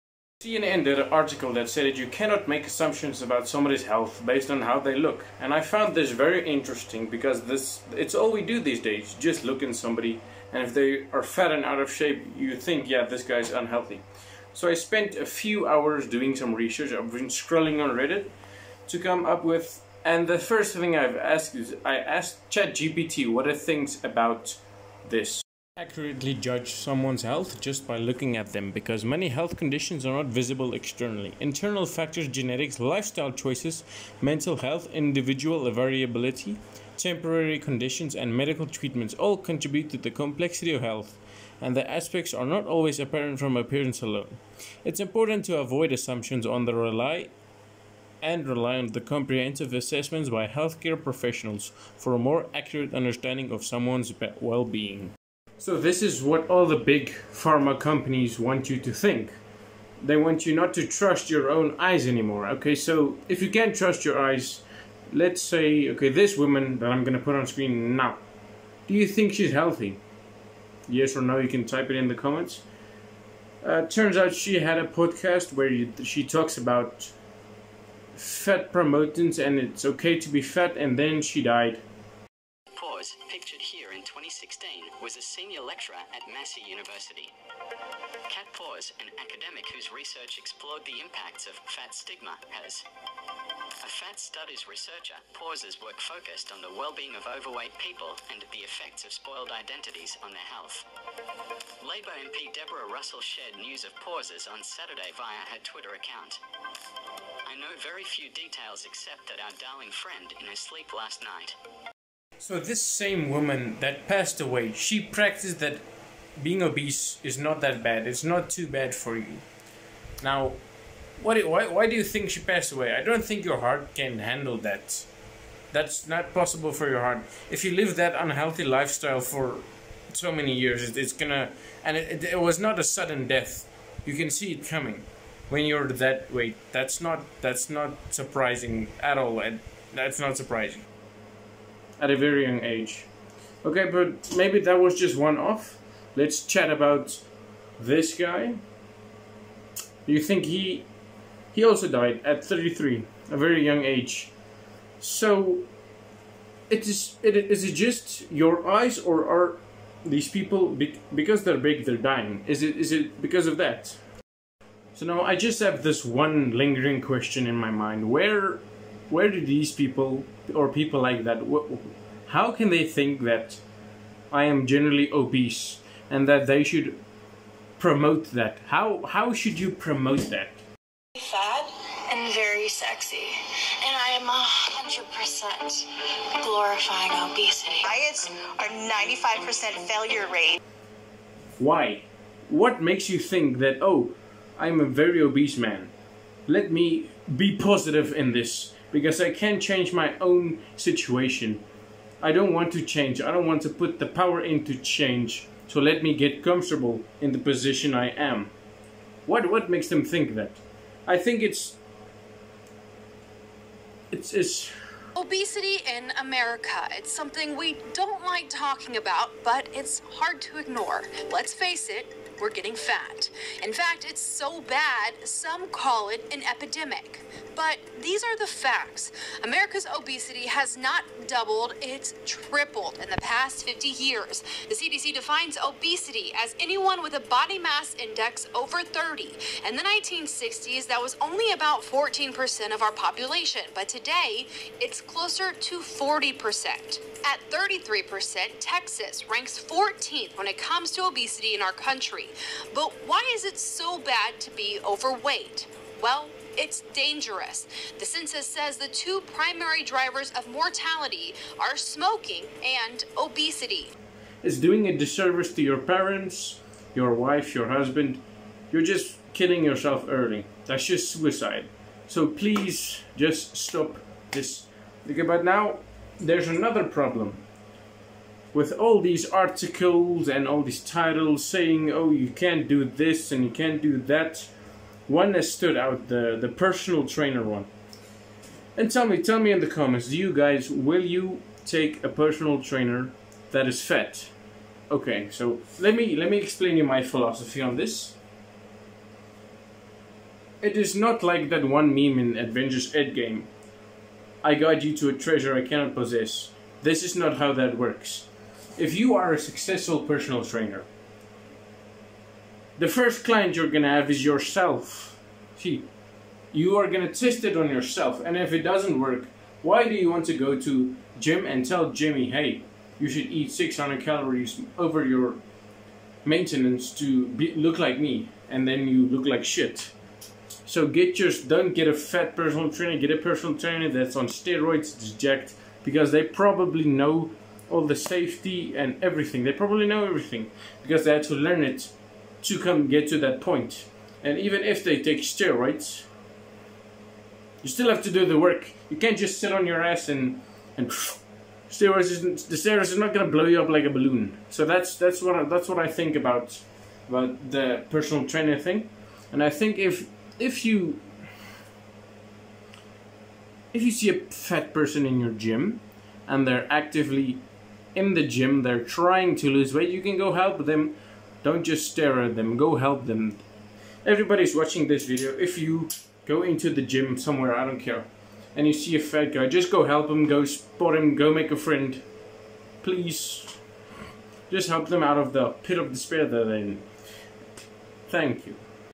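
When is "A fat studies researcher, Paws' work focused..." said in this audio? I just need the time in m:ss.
1:33.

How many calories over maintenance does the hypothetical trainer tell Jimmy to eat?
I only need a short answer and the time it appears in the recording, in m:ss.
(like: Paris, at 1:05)
600, at 5:23.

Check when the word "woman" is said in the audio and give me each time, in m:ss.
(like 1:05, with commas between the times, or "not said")
1:06, 1:53.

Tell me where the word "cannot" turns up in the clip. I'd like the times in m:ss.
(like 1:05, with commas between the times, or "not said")
0:02, 5:05.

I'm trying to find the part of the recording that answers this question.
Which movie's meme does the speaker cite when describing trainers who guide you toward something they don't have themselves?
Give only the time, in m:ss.
5:02.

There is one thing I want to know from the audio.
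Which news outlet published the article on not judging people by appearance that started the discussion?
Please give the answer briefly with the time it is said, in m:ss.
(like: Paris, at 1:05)
CNN, at 0:00.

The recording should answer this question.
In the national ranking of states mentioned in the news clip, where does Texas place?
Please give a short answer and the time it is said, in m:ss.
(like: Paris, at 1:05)
14th, at 4:09.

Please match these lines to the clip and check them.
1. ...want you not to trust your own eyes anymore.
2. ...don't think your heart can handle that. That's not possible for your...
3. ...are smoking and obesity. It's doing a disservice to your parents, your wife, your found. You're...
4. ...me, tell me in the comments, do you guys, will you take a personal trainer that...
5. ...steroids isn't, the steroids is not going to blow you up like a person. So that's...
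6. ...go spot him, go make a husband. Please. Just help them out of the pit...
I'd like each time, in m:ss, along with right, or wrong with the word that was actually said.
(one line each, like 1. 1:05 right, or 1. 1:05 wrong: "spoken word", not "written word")
1. 1:00 right
2. 2:03 right
3. 4:21 wrong: "husband", not "found"
4. 4:49 right
5. 5:51 wrong: "balloon", not "person"
6. 6:20 wrong: "friend", not "husband".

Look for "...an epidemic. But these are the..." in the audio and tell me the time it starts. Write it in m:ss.
3:46.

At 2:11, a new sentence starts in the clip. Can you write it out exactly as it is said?
And it, it, it was not a sudden death.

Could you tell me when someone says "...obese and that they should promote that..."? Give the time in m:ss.
2:55.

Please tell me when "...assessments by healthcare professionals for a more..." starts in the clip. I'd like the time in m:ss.
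0:49.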